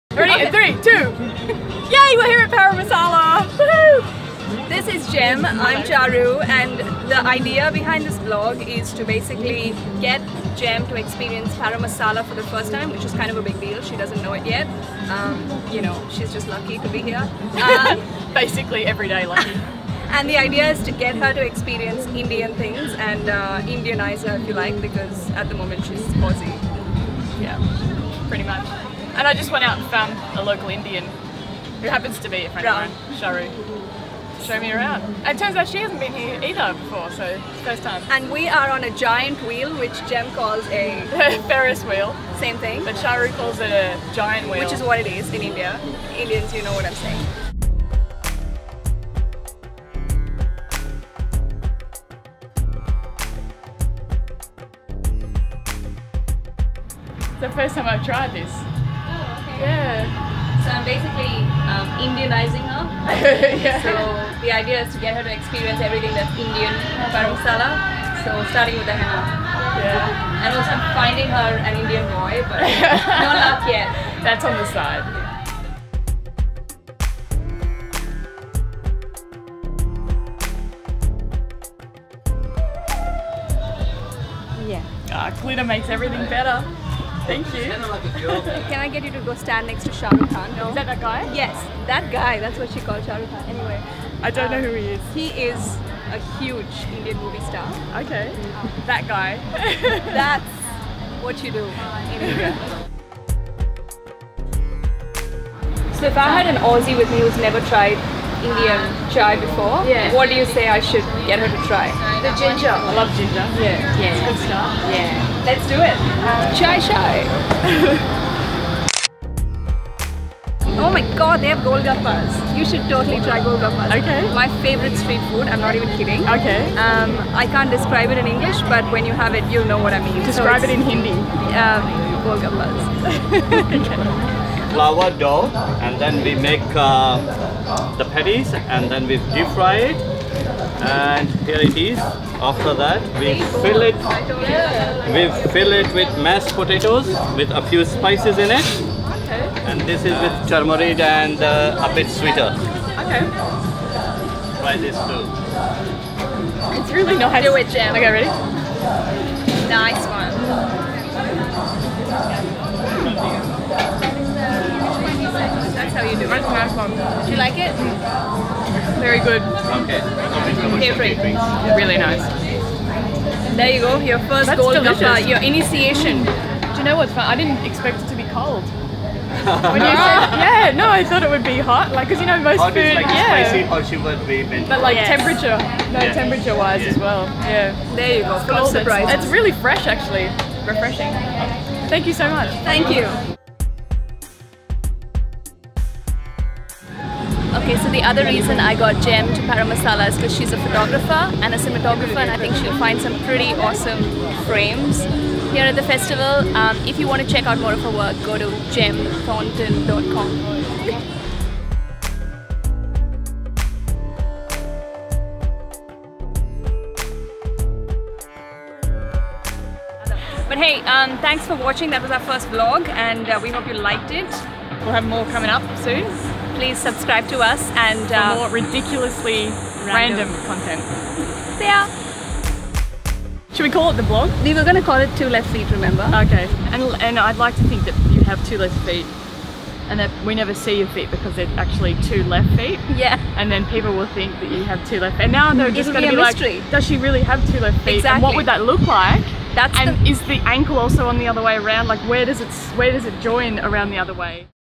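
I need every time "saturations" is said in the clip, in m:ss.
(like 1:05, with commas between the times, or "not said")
not said.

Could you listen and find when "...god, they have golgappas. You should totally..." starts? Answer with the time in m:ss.
2:01.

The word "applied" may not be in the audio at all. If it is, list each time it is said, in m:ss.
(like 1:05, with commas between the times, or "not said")
not said.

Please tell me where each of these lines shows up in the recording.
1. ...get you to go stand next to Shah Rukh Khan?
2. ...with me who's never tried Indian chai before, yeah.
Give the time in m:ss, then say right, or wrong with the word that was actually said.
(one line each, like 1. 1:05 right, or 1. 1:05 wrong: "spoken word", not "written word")
1. 1:28 right
2. 1:46 right.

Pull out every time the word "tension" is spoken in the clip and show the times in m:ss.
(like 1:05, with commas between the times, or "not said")
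not said.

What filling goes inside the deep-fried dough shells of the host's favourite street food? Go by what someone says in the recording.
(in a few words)
Mashed potatoes.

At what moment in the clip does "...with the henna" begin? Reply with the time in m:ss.
1:08.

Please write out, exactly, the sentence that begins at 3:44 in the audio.
We'll have more coming up soon please subscribe to us and uh, more ridiculously random.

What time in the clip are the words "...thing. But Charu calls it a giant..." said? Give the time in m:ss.
0:42.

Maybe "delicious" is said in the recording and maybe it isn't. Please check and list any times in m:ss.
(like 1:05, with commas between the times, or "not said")
2:54.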